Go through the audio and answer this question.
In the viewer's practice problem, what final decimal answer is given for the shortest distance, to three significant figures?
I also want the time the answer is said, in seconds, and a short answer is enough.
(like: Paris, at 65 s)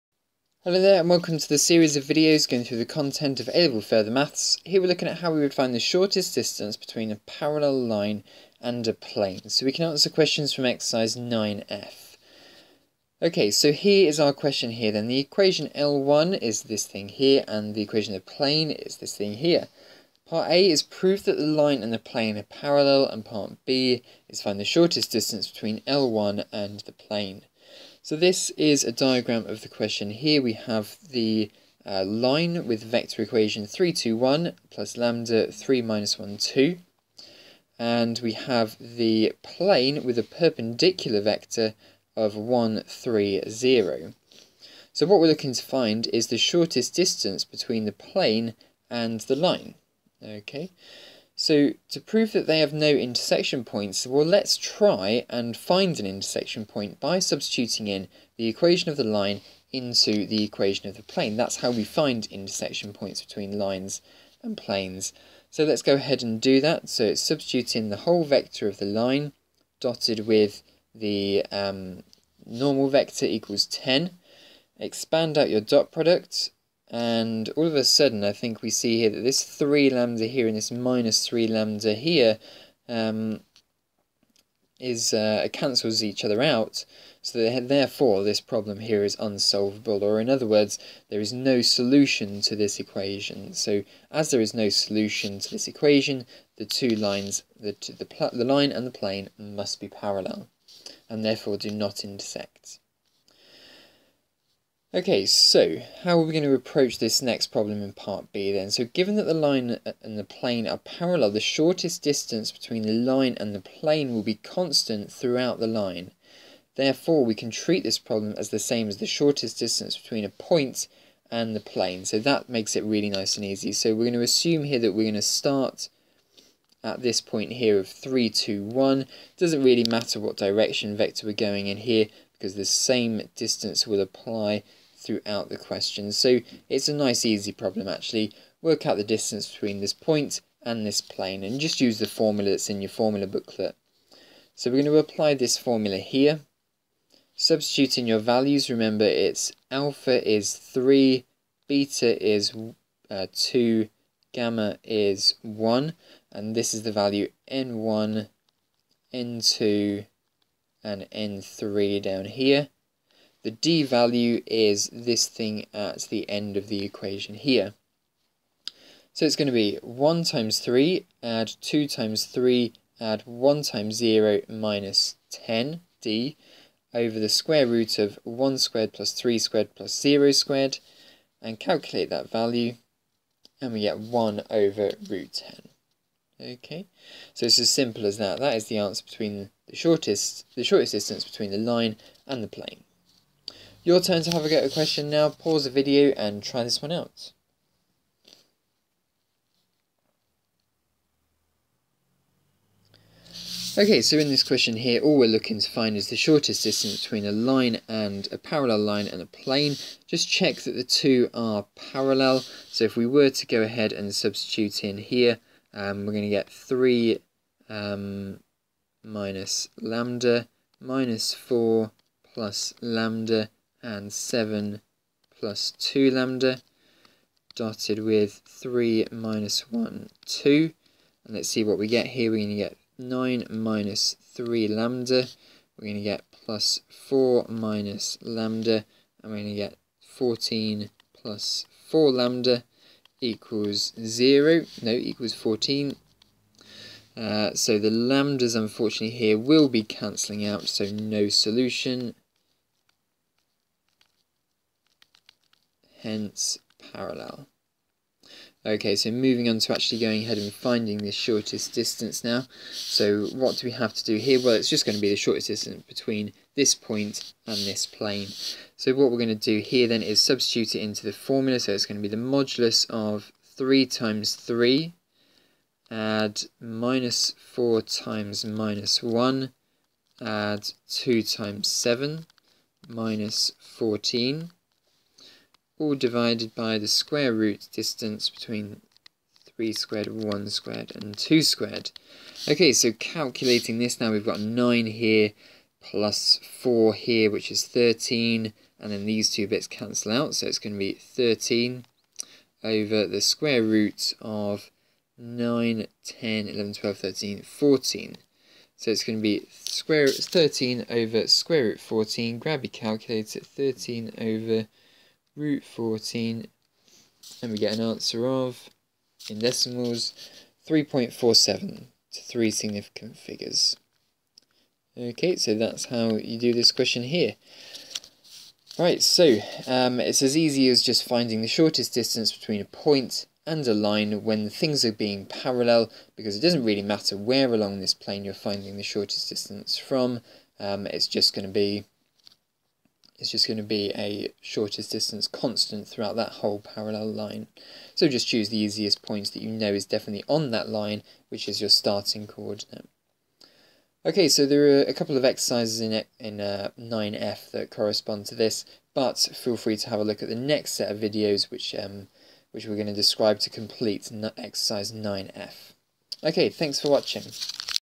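3.47, at 320 s.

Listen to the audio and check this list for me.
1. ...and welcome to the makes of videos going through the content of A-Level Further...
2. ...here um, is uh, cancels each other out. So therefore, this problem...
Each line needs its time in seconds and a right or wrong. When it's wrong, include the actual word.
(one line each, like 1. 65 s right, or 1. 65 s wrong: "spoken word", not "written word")
1. 0 s wrong: "series", not "makes"
2. 81 s right.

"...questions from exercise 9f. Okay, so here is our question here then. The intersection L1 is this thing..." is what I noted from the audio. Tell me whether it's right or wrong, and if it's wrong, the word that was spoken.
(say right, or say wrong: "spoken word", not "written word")
wrong: "equation", not "intersection".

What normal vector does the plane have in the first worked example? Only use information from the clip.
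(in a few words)
1, 3, 0.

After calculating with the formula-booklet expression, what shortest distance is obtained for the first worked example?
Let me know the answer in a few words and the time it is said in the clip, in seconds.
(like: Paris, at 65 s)
1 over root 10, at 183 s.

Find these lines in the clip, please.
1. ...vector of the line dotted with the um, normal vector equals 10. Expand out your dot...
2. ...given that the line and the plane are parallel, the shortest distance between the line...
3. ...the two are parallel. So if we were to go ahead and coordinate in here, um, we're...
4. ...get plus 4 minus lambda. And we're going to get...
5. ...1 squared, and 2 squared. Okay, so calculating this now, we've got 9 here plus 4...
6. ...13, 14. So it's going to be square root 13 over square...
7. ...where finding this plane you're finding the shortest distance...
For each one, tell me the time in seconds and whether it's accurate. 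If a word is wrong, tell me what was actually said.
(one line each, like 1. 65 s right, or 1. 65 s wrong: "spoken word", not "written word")
1. 68 s right
2. 108 s right
3. 210 s wrong: "substitute", not "coordinate"
4. 236 s right
5. 290 s right
6. 306 s right
7. 337 s wrong: "along", not "finding".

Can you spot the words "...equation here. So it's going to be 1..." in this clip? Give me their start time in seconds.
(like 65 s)
166 s.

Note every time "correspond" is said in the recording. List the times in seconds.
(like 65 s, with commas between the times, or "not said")
357 s.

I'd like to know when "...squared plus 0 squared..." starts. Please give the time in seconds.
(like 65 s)
179 s.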